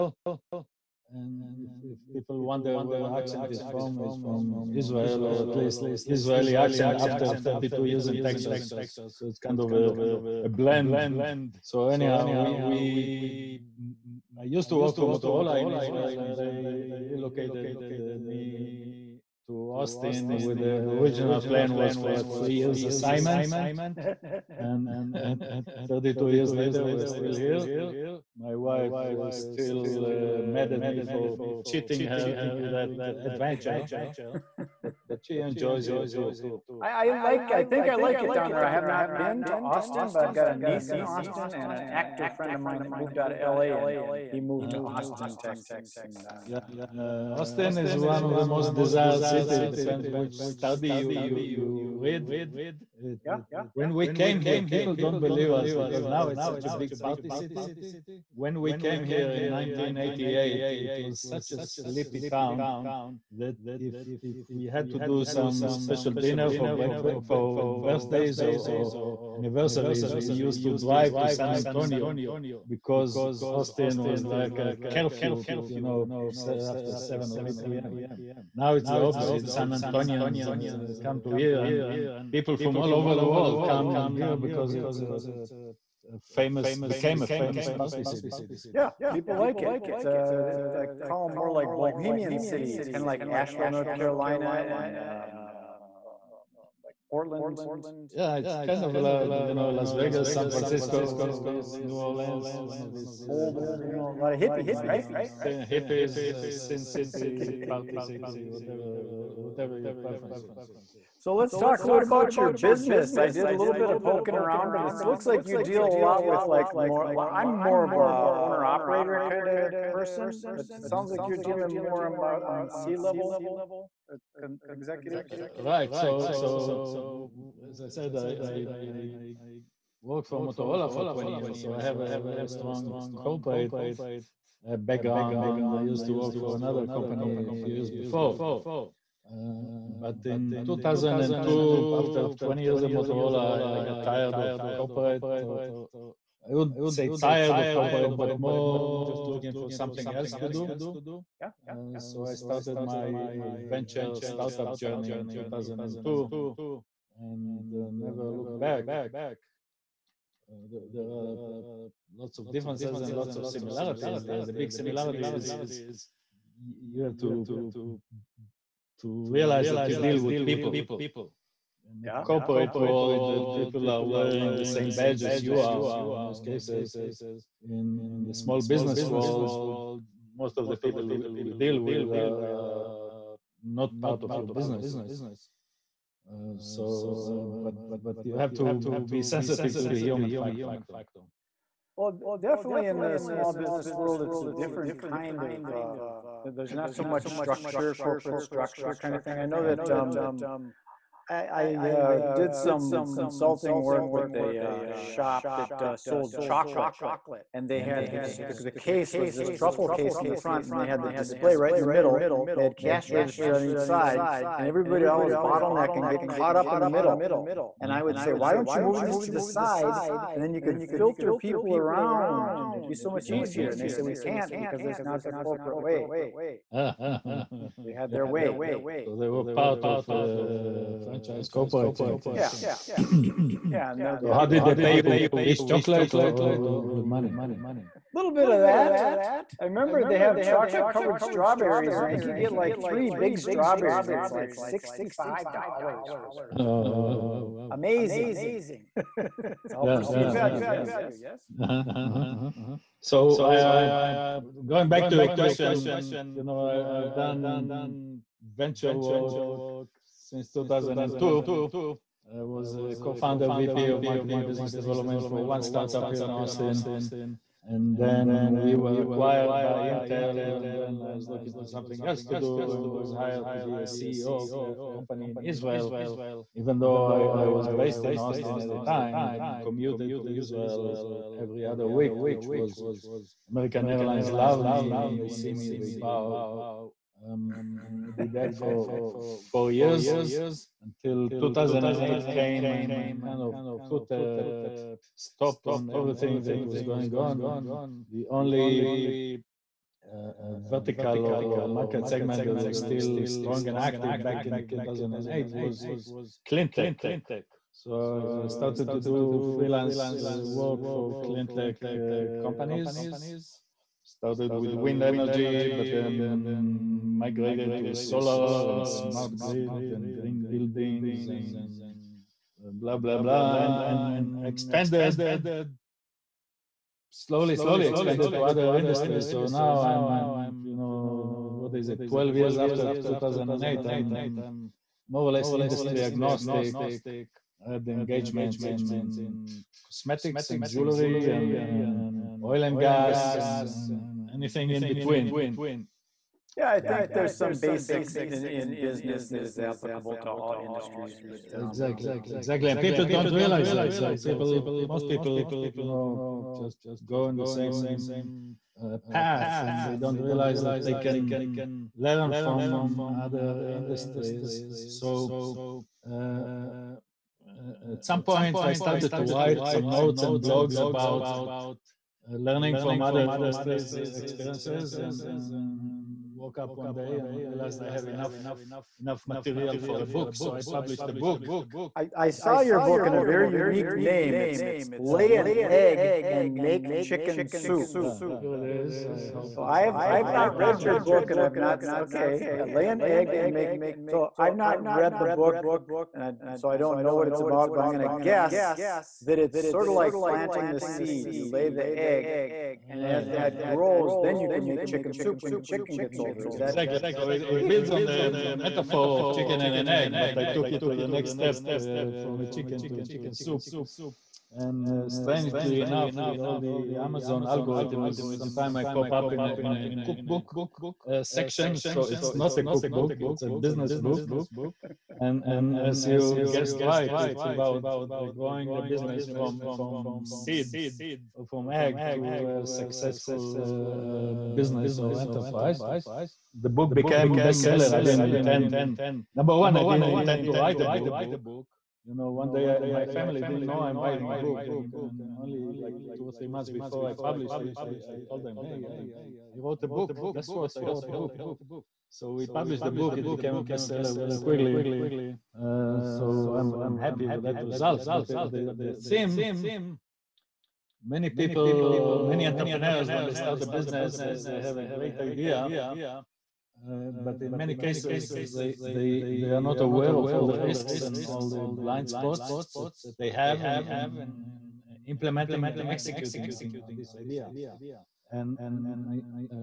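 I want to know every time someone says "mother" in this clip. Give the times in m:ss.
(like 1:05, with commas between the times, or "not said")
not said.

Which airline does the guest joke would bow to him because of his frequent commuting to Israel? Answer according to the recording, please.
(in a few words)
American Airlines.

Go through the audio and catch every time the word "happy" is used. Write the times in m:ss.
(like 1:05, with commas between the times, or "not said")
7:36.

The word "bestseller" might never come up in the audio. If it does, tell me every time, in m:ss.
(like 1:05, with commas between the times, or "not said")
7:17, 7:33.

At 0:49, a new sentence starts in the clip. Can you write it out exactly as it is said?
Depends which study you you you read.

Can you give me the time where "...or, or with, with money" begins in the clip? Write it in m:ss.
3:56.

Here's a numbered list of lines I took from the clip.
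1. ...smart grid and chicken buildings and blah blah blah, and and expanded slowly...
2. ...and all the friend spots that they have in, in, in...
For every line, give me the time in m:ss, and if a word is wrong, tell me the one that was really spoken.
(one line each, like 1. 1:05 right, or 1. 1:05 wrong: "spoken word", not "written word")
1. 5:18 wrong: "green", not "chicken"
2. 7:51 wrong: "blind", not "friend".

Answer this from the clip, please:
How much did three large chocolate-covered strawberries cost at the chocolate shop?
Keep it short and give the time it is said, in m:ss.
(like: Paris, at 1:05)
$65, at 4:04.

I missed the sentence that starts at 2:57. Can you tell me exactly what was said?
In, in the small business world, most of the people you deal with are, are not part of your business.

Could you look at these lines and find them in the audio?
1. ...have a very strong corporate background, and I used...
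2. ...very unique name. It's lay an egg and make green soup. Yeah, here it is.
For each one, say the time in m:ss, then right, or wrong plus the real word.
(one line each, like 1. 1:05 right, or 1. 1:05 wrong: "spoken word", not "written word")
1. 2:11 right
2. 6:23 wrong: "chicken", not "green".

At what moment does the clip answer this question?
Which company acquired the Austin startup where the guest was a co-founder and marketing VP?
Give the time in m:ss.
4:29.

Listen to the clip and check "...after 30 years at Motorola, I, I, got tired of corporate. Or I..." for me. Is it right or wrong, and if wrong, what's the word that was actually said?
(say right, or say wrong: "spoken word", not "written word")
wrong: "20", not "30".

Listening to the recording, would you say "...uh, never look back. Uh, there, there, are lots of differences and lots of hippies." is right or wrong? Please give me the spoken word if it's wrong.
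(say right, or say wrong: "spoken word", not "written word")
wrong: "similarities", not "hippies".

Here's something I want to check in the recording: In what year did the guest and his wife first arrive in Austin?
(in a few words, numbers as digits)
1988.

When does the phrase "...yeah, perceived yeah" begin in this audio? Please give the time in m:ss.
4:09.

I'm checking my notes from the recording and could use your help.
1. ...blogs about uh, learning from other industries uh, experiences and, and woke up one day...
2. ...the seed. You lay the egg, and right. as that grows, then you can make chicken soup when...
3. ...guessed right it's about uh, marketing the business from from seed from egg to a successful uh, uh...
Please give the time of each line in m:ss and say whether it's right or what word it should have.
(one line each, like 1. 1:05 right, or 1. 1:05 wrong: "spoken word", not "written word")
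1. 6:10 right
2. 6:40 right
3. 7:06 wrong: "growing", not "marketing".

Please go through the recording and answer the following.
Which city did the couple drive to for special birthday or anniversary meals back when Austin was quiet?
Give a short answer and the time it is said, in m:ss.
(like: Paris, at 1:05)
San Antonio, at 1:11.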